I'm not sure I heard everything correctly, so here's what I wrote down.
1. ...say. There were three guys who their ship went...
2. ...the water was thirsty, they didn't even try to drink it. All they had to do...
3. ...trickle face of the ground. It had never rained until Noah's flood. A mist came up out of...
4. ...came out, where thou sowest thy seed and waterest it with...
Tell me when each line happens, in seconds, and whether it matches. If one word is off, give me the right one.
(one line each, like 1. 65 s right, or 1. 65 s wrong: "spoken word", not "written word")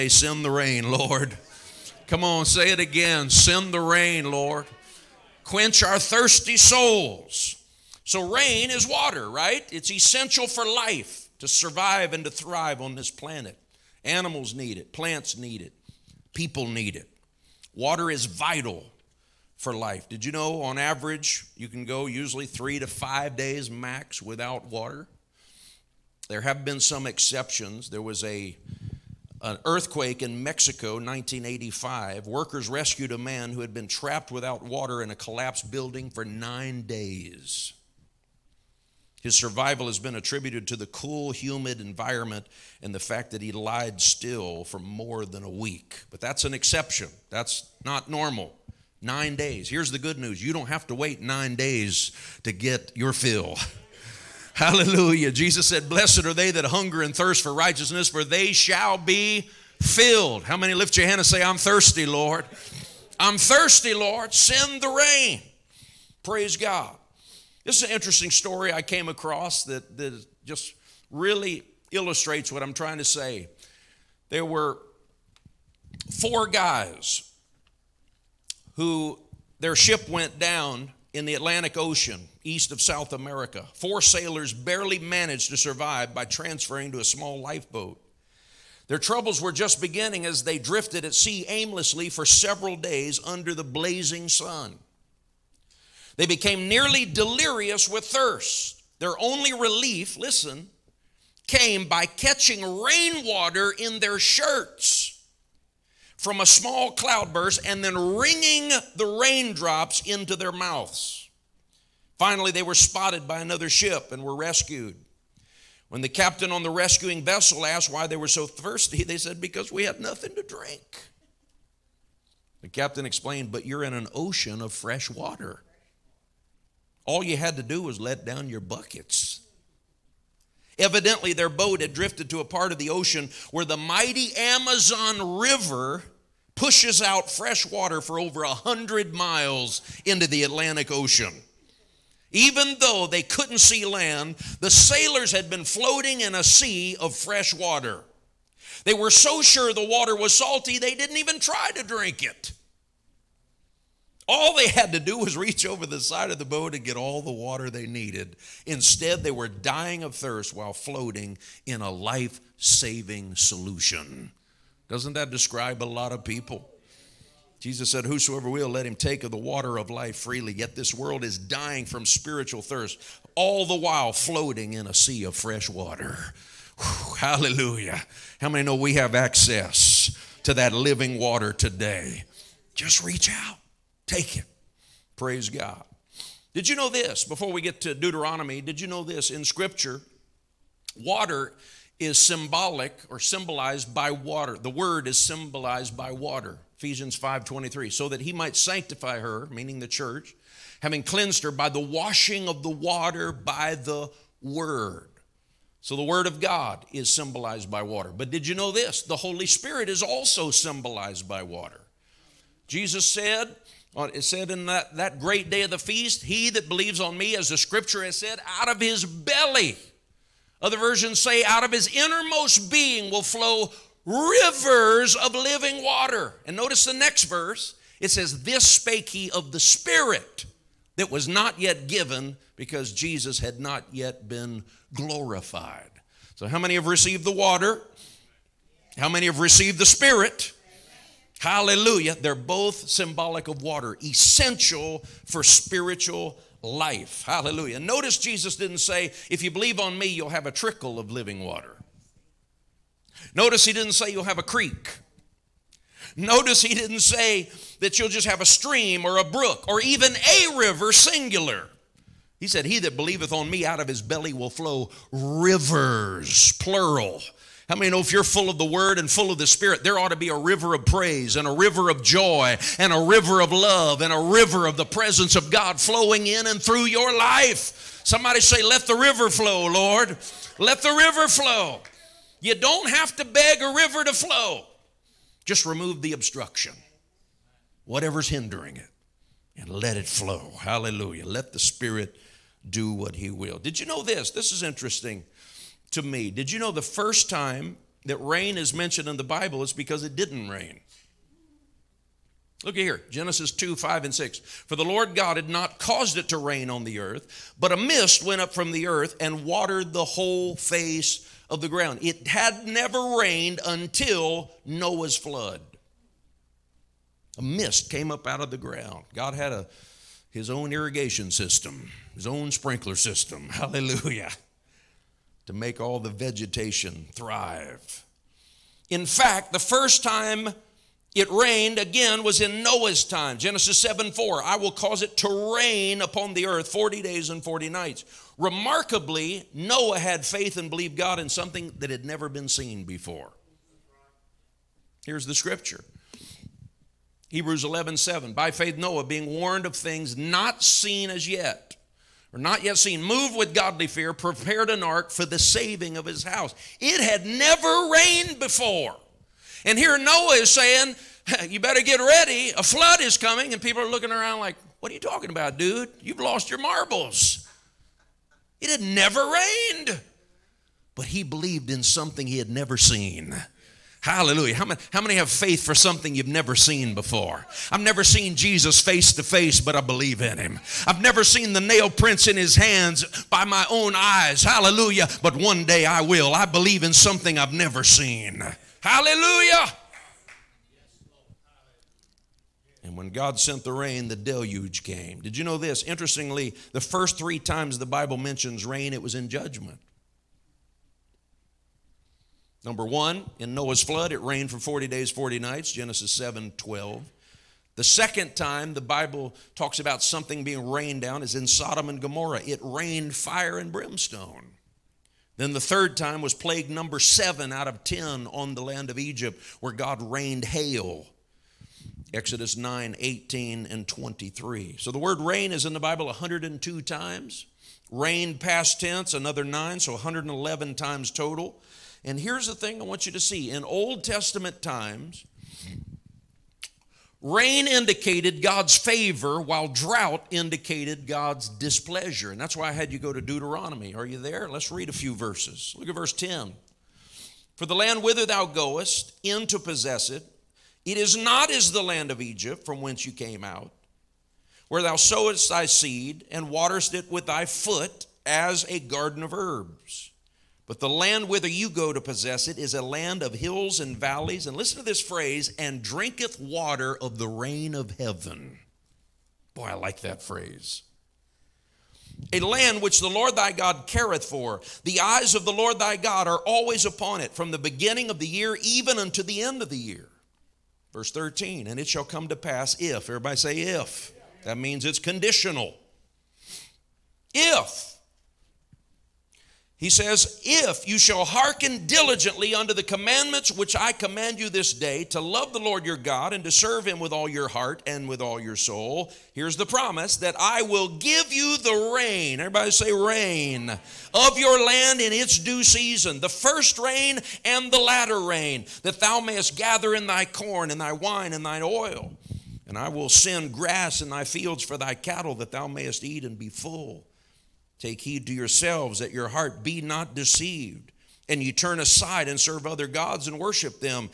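1. 73 s wrong: "four", not "three"
2. 149 s wrong: "salty", not "thirsty"
3. 310 s wrong: "whole", not "trickle"
4. 453 s right.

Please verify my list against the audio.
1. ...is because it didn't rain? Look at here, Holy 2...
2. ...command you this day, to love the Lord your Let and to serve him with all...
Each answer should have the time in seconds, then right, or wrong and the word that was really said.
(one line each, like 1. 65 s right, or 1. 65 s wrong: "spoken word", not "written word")
1. 299 s wrong: "Genesis", not "Holy"
2. 493 s wrong: "God", not "Let".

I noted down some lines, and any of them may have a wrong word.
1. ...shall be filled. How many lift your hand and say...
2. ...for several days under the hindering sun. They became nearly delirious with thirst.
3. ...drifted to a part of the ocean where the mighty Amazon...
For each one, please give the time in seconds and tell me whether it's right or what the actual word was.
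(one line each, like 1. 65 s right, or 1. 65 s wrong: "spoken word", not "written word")
1. 58 s right
2. 92 s wrong: "blazing", not "hindering"
3. 131 s right.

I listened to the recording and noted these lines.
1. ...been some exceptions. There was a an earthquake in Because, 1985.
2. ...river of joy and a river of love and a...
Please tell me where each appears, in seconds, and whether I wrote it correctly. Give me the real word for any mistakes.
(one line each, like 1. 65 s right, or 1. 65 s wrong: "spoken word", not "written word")
1. 26 s wrong: "Mexico", not "Because"
2. 271 s right.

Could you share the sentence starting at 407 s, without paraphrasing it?
The second time the Bible talks about something being rained down is in Sodom and Gomorrah.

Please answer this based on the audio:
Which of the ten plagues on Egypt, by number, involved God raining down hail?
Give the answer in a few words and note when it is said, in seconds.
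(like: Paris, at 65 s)
7, at 416 s.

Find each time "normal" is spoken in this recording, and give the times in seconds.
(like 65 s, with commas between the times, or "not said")
48 s.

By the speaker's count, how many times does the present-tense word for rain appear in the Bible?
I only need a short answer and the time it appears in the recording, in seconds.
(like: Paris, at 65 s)
102, at 426 s.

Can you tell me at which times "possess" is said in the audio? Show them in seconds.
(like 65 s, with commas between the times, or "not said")
449 s, 461 s.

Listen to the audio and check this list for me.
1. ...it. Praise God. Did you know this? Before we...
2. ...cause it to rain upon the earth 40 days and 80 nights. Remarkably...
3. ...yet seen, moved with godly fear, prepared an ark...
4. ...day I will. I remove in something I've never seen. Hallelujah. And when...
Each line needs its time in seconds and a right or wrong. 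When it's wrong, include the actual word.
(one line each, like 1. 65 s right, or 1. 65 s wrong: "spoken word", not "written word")
1. 184 s right
2. 334 s wrong: "40", not "80"
3. 352 s right
4. 385 s wrong: "believe", not "remove".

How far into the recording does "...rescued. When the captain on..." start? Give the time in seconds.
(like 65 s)
114 s.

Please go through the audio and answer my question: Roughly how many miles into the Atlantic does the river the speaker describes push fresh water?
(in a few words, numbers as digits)
100 miles.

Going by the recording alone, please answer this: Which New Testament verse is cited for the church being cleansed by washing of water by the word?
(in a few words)
Ephesians 5:23.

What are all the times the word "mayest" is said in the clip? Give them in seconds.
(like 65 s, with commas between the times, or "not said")
509 s, 515 s.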